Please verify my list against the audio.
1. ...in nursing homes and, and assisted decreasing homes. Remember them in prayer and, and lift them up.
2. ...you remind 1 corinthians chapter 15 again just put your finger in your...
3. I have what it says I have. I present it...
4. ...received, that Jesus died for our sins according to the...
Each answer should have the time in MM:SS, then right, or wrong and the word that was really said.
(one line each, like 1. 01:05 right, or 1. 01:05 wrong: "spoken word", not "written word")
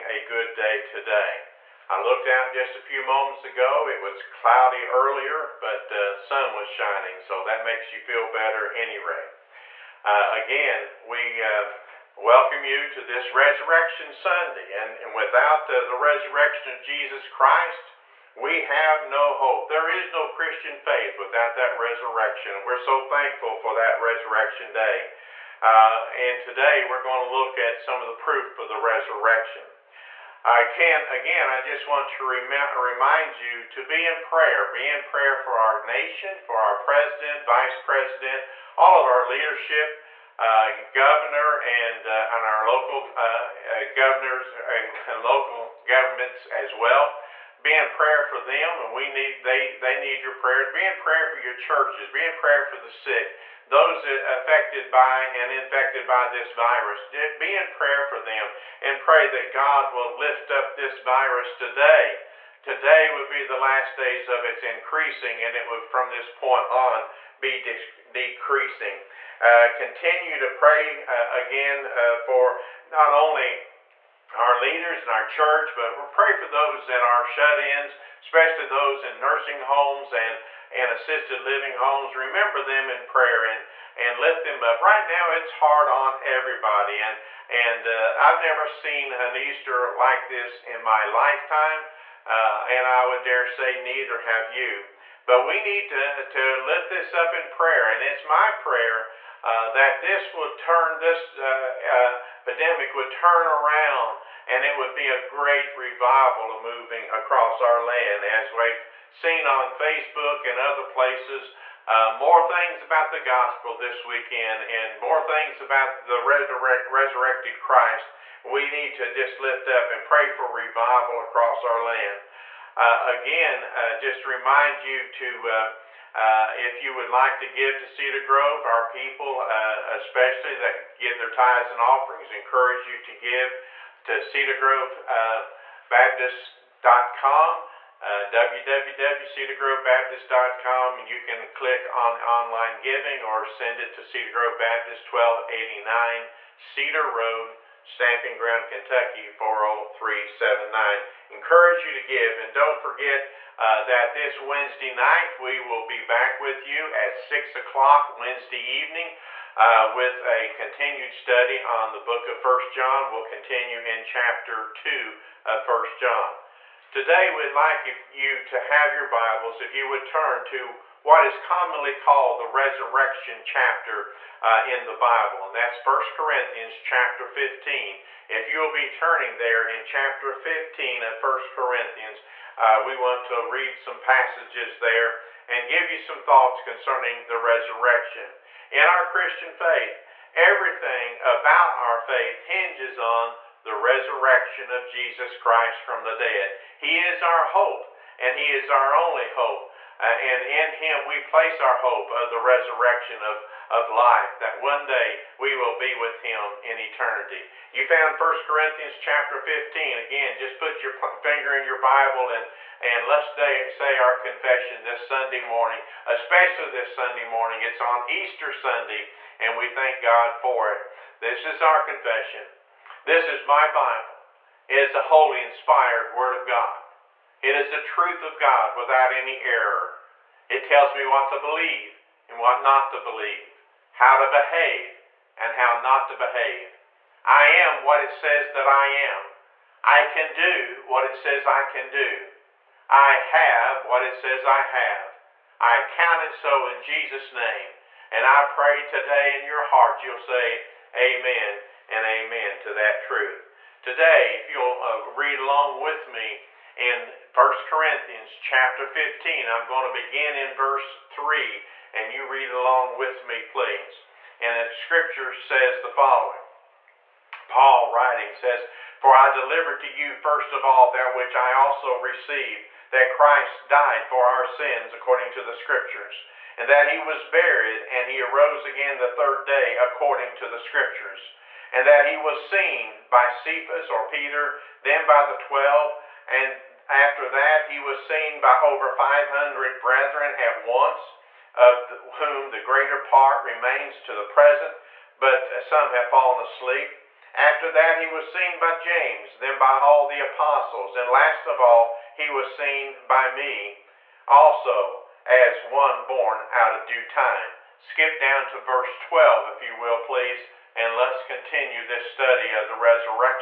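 1. 01:19 wrong: "living", not "decreasing"
2. 03:27 wrong: "found", not "remind"
3. 04:02 wrong: "count", not "present"
4. 04:31 wrong: "Christ", not "Jesus".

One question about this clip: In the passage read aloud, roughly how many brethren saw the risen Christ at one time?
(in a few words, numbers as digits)
500.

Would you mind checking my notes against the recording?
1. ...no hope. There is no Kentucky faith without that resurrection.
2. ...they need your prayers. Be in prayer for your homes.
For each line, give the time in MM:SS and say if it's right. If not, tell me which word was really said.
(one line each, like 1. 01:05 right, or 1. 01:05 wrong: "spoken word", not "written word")
1. 00:19 wrong: "Christian", not "Kentucky"
2. 00:49 wrong: "churches", not "homes".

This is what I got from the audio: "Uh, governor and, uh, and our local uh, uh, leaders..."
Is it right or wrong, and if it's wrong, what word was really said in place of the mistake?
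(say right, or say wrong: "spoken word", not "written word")
wrong: "governors", not "leaders".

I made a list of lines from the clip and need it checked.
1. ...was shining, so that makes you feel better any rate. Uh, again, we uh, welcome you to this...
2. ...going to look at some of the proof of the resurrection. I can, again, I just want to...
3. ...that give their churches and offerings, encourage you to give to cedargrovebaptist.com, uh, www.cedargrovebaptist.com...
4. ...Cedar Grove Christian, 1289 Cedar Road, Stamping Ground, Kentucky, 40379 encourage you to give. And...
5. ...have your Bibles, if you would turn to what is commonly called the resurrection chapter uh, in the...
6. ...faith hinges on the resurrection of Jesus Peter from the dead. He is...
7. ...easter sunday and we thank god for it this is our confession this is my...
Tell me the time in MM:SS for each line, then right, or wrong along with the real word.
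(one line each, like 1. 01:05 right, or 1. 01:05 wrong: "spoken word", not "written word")
1. 00:06 right
2. 00:27 right
3. 02:10 wrong: "tithes", not "churches"
4. 02:24 wrong: "Baptist", not "Christian"
5. 02:48 right
6. 03:11 wrong: "Christ", not "Peter"
7. 03:38 right.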